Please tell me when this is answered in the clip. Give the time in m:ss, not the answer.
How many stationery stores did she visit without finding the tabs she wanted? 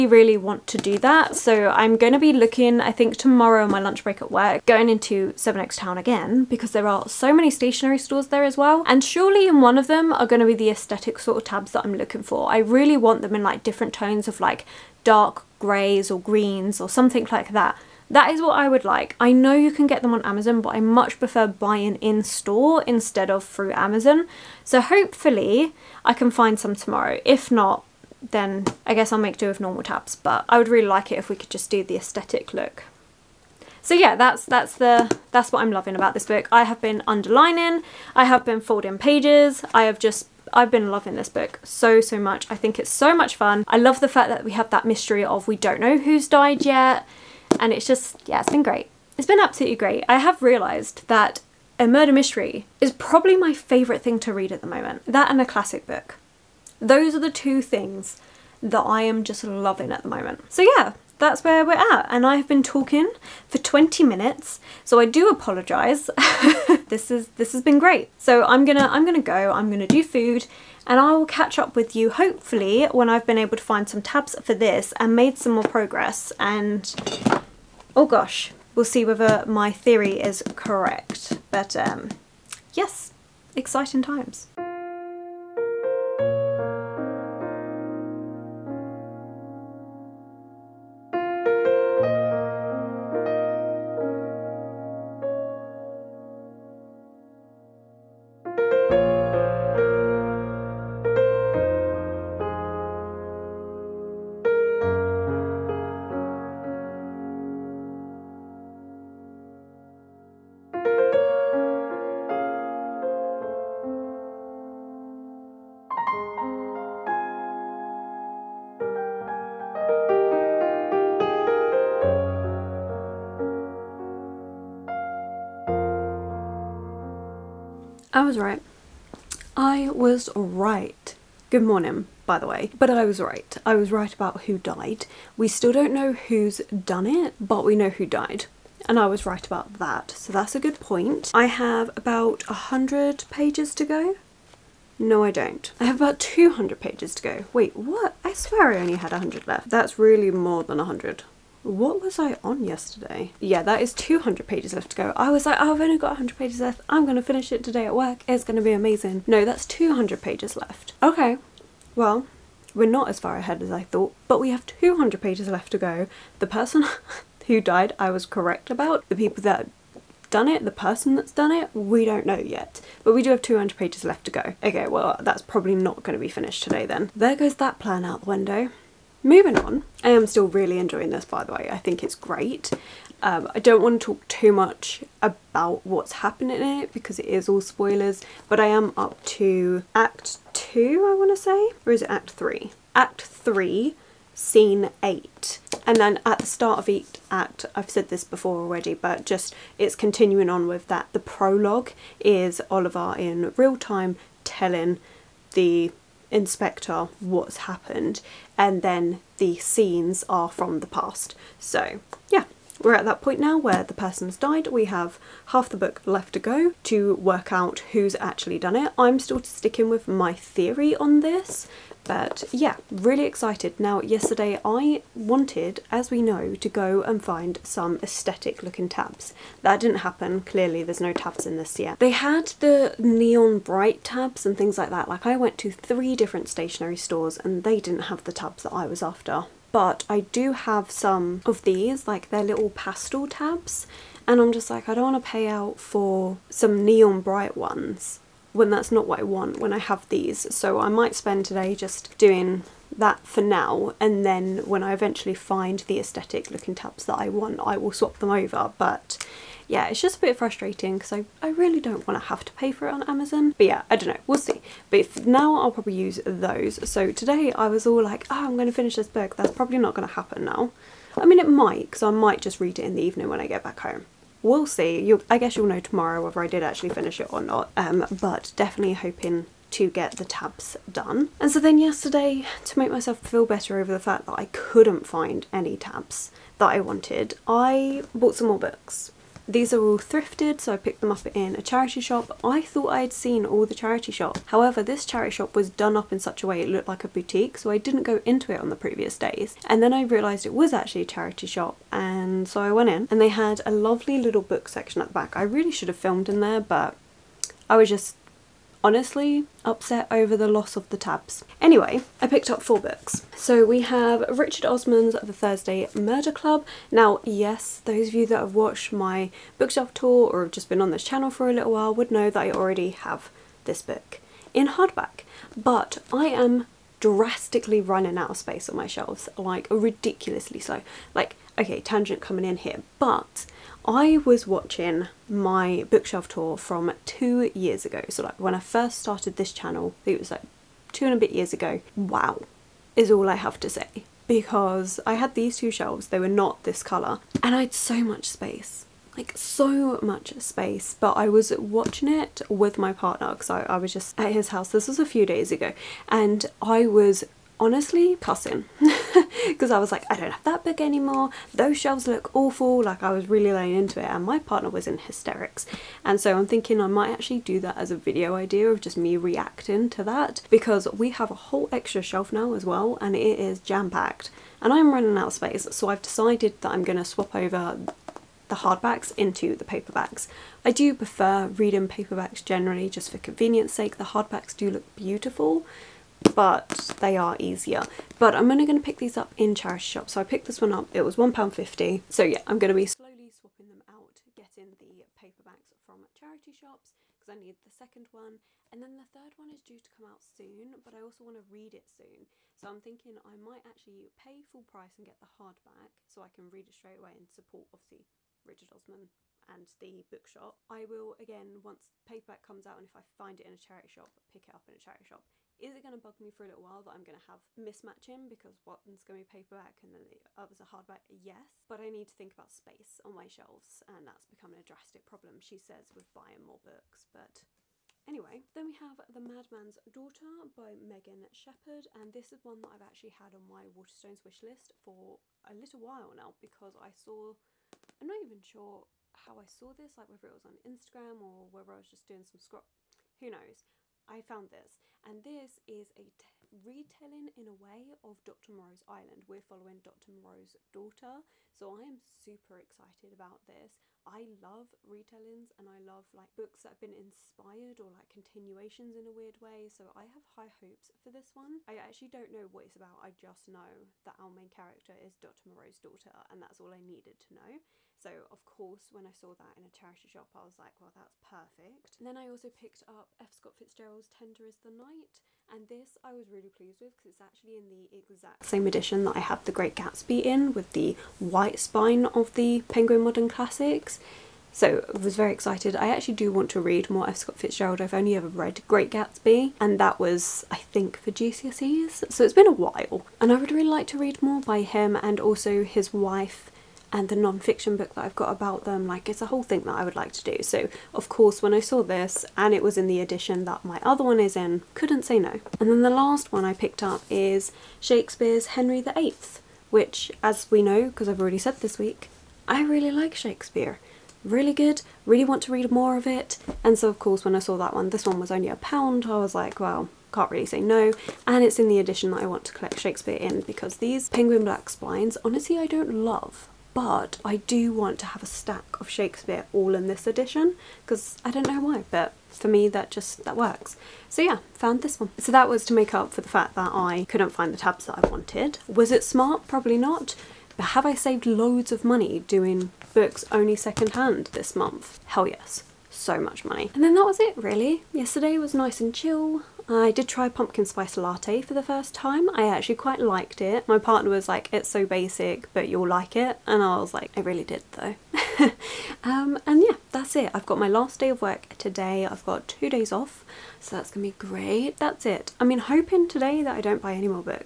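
3:55.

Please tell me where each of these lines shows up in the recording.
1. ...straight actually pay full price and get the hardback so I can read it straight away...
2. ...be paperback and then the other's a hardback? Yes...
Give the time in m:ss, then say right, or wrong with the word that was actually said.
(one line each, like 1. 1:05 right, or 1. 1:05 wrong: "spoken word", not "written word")
1. 6:43 wrong: "might", not "straight"
2. 6:59 right.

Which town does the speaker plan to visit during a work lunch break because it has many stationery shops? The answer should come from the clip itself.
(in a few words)
Sevenoaks.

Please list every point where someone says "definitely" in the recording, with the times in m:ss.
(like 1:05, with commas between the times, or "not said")
4:38.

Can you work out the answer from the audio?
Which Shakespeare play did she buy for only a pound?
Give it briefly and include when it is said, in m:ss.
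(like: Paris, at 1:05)
Henry VIII, at 8:28.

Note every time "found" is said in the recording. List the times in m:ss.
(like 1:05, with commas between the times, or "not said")
7:24, 8:54.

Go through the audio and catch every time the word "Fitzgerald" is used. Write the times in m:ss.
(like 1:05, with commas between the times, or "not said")
7:53, 8:07.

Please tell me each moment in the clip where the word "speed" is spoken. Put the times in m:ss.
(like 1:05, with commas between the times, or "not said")
not said.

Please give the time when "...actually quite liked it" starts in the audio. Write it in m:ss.
9:12.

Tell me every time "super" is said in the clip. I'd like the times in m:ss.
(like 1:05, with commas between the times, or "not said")
7:31.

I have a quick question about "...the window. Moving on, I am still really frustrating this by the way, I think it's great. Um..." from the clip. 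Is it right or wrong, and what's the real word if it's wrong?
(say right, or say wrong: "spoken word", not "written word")
wrong: "enjoying", not "frustrating".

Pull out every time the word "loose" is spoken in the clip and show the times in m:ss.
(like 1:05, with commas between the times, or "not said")
not said.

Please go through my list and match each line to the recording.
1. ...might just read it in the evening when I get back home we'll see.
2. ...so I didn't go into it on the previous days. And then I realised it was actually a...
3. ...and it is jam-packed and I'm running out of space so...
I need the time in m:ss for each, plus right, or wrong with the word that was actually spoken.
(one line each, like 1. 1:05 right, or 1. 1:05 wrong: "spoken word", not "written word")
1. 4:32 right
2. 4:57 right
3. 6:12 right.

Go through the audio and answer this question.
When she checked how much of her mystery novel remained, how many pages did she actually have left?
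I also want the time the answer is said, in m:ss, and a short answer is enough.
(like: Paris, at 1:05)
200, at 2:26.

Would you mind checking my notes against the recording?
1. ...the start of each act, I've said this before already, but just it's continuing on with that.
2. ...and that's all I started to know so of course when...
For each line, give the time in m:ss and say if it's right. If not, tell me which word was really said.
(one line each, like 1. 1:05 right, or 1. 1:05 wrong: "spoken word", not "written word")
1. 3:16 right
2. 7:46 wrong: "needed", not "started".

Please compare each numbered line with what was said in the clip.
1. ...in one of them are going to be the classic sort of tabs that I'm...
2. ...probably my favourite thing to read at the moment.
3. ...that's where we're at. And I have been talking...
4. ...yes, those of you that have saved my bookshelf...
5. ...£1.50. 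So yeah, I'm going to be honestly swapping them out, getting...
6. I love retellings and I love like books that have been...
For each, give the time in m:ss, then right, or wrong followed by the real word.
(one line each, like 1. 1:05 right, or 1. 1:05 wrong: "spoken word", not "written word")
1. 0:09 wrong: "aesthetic", not "classic"
2. 0:52 right
3. 1:01 right
4. 5:17 wrong: "watched", not "saved"
5. 6:31 wrong: "slowly", not "honestly"
6. 7:34 right.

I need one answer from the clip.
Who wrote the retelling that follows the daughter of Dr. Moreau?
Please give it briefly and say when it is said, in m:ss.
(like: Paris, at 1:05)
Megan Shepherd, at 7:10.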